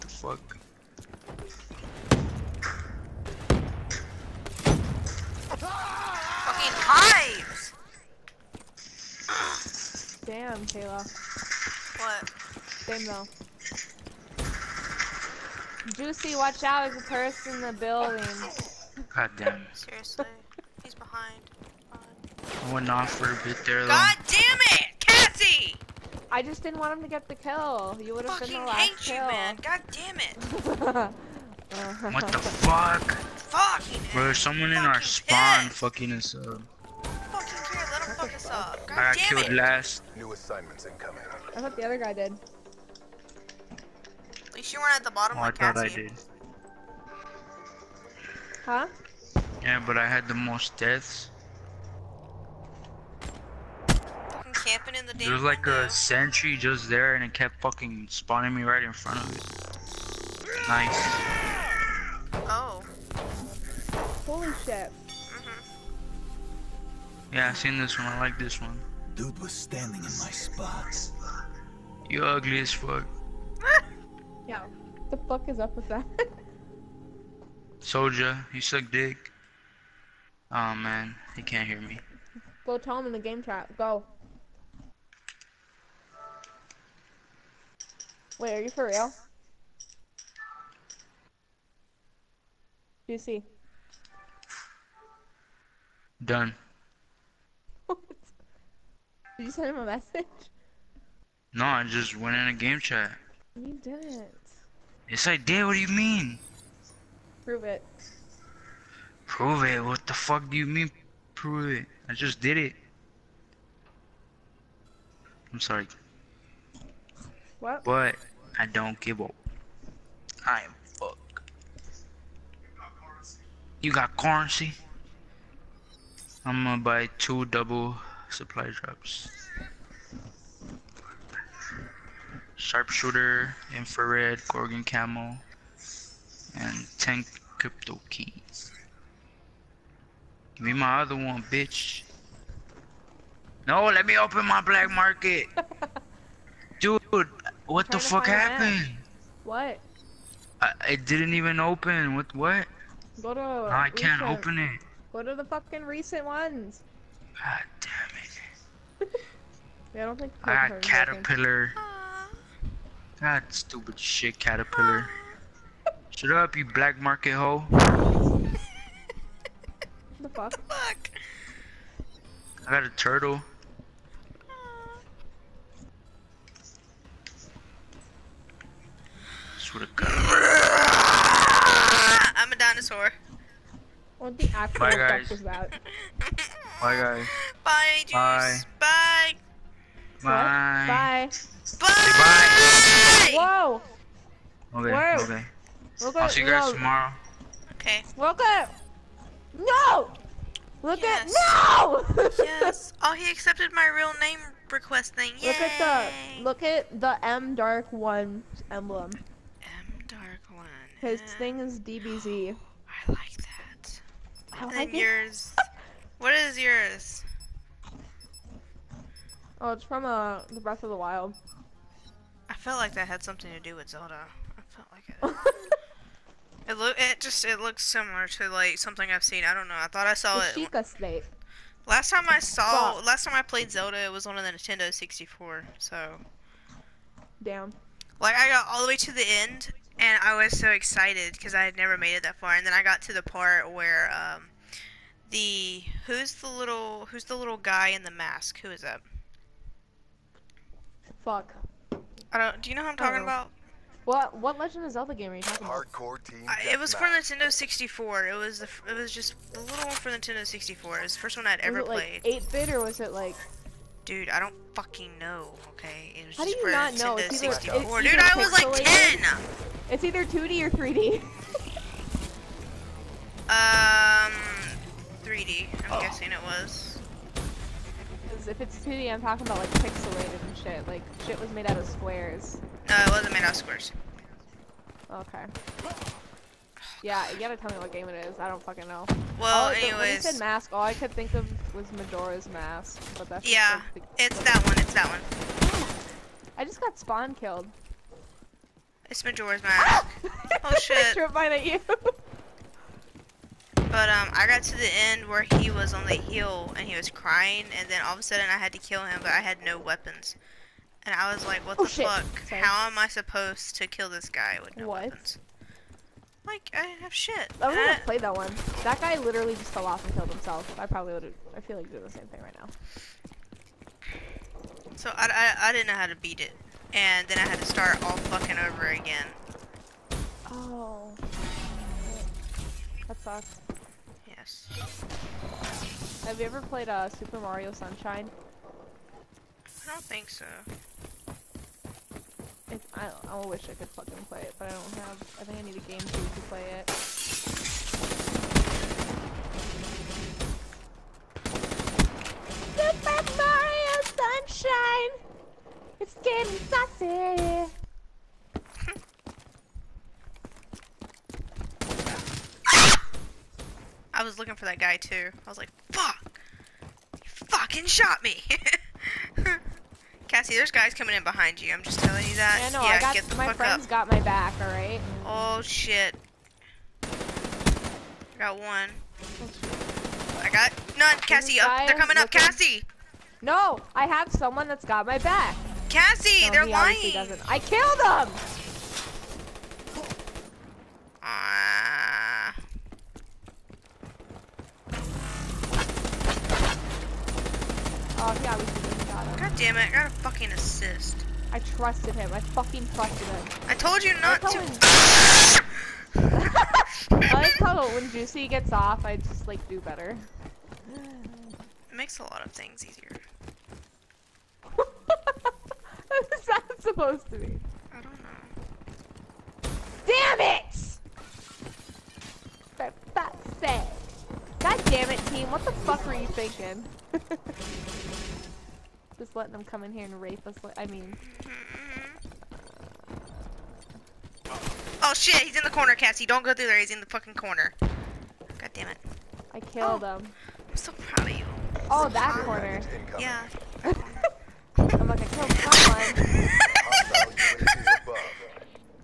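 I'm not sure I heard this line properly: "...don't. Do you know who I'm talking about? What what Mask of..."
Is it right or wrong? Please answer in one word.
wrong.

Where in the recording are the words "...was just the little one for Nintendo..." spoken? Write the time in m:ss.
4:18.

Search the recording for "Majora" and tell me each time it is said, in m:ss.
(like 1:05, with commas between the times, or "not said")
4:51, 4:59.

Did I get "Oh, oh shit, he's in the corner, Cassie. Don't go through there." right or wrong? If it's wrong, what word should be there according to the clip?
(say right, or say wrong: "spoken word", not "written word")
right.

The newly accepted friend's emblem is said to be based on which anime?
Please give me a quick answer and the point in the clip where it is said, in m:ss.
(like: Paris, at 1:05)
DBZ, at 3:31.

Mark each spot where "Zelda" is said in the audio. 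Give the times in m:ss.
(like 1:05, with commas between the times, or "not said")
3:43, 3:53, 4:14.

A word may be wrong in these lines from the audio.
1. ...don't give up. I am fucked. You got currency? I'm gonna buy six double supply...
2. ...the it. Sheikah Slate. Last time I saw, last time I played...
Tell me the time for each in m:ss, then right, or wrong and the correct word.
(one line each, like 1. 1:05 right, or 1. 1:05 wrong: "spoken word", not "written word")
1. 1:58 wrong: "two", not "six"
2. 3:50 right.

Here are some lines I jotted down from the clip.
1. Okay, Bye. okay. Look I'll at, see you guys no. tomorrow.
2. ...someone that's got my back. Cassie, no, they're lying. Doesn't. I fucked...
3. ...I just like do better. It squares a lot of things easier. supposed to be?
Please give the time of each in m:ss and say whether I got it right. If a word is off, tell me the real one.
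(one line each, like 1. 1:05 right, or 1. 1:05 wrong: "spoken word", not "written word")
1. 3:14 wrong: "Whoa", not "Bye"
2. 6:24 wrong: "killed", not "fucked"
3. 6:49 wrong: "makes", not "squares".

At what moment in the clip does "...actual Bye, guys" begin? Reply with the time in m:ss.
3:04.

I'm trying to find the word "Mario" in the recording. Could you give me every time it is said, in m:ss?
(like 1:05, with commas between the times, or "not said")
5:37, 5:53.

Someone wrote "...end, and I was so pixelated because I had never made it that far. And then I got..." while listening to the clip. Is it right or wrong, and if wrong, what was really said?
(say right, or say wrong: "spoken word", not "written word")
wrong: "excited", not "pixelated".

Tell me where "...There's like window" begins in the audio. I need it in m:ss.
0:55.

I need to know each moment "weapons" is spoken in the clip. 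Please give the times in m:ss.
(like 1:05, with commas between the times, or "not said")
5:09, 5:15.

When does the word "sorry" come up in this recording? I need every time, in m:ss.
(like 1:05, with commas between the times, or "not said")
1:55, 5:12.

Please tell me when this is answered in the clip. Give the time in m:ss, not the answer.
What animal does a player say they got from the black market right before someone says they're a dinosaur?
2:52.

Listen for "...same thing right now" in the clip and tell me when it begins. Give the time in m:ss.
5:22.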